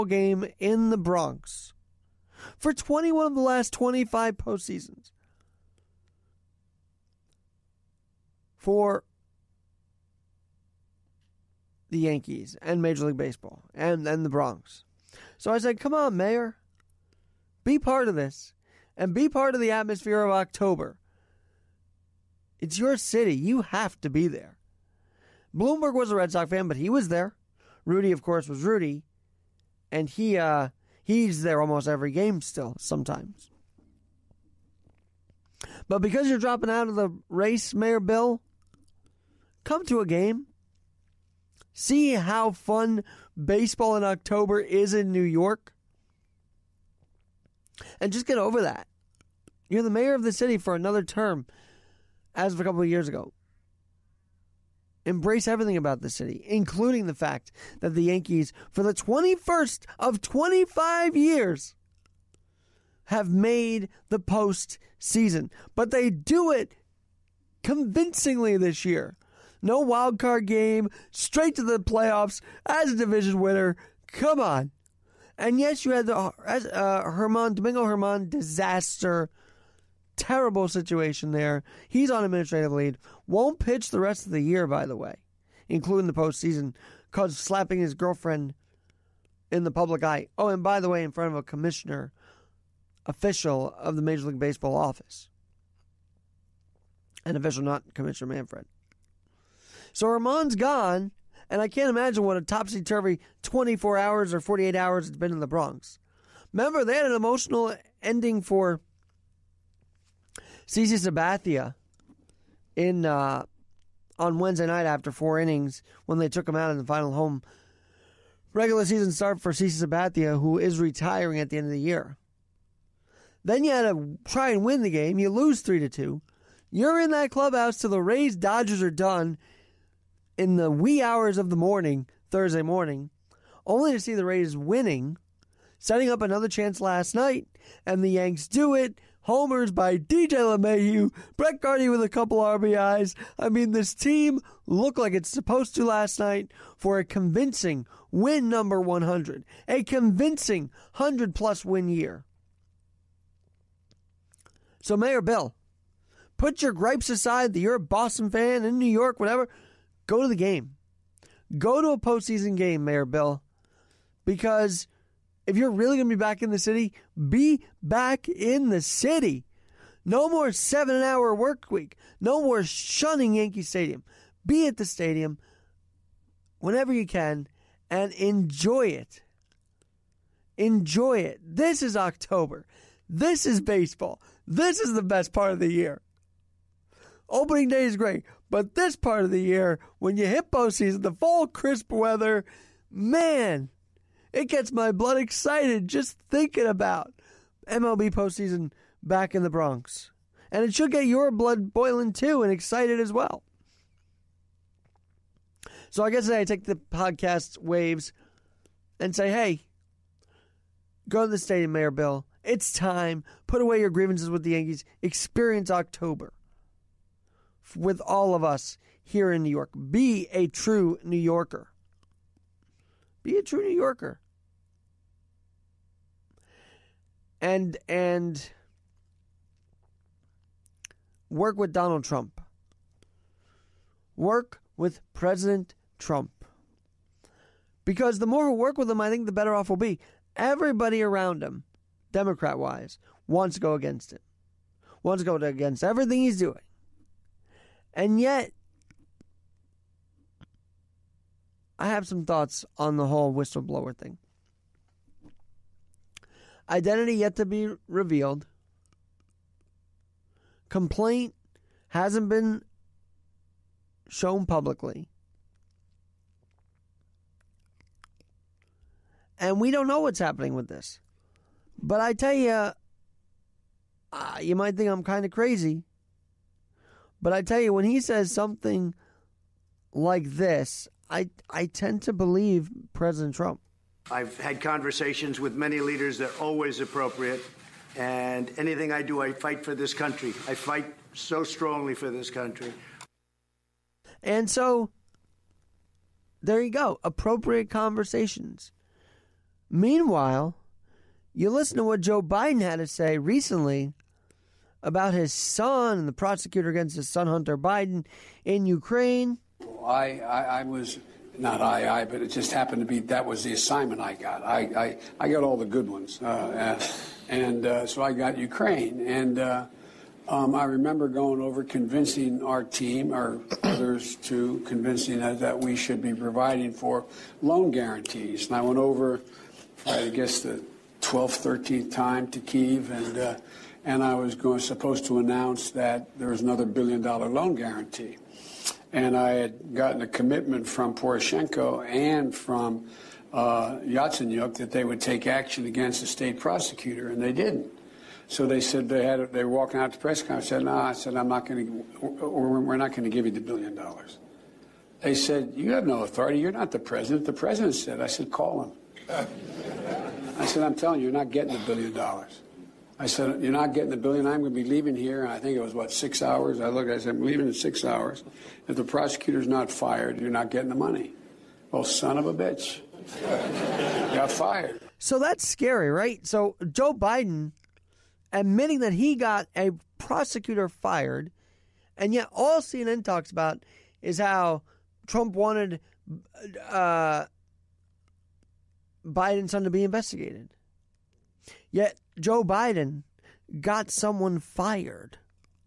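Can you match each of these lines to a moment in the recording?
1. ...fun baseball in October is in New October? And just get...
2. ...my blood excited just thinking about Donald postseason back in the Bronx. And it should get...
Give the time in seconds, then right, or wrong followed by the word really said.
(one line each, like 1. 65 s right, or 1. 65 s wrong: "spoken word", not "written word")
1. 42 s wrong: "York", not "October"
2. 194 s wrong: "MLB", not "Donald".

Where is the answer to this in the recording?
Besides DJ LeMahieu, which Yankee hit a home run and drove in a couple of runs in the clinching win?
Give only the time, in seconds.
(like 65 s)
141 s.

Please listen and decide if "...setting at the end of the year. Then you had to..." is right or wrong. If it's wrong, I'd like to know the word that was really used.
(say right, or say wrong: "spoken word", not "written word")
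wrong: "retiring", not "setting".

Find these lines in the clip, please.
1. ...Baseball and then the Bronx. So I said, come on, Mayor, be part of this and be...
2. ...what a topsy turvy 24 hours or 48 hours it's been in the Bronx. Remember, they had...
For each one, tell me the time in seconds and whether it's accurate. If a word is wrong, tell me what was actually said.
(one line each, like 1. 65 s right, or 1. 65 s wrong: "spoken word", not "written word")
1. 13 s right
2. 102 s right.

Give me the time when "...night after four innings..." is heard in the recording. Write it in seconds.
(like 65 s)
114 s.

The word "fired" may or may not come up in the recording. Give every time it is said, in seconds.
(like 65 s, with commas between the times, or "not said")
369 s, 374 s, 380 s, 394 s.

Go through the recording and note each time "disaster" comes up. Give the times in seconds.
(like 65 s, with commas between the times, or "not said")
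78 s.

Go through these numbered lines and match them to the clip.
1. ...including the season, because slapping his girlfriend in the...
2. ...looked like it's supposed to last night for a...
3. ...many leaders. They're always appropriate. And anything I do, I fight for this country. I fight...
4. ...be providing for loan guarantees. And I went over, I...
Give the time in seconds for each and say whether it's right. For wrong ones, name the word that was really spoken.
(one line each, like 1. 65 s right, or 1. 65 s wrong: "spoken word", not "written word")
1. 85 s wrong: "postseason", not "season"
2. 144 s right
3. 285 s right
4. 326 s right.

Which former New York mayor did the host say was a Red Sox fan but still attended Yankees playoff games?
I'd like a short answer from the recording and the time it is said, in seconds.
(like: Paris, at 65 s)
Bloomberg, at 25 s.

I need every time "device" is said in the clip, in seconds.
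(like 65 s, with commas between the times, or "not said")
not said.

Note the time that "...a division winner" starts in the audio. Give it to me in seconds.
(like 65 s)
72 s.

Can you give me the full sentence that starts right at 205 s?
So I guess I take the podcast waves and say, hey, go to the stadium, Mayor Bill.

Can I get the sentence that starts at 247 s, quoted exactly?
And yet, I have some thoughts on the whole whistleblower thing.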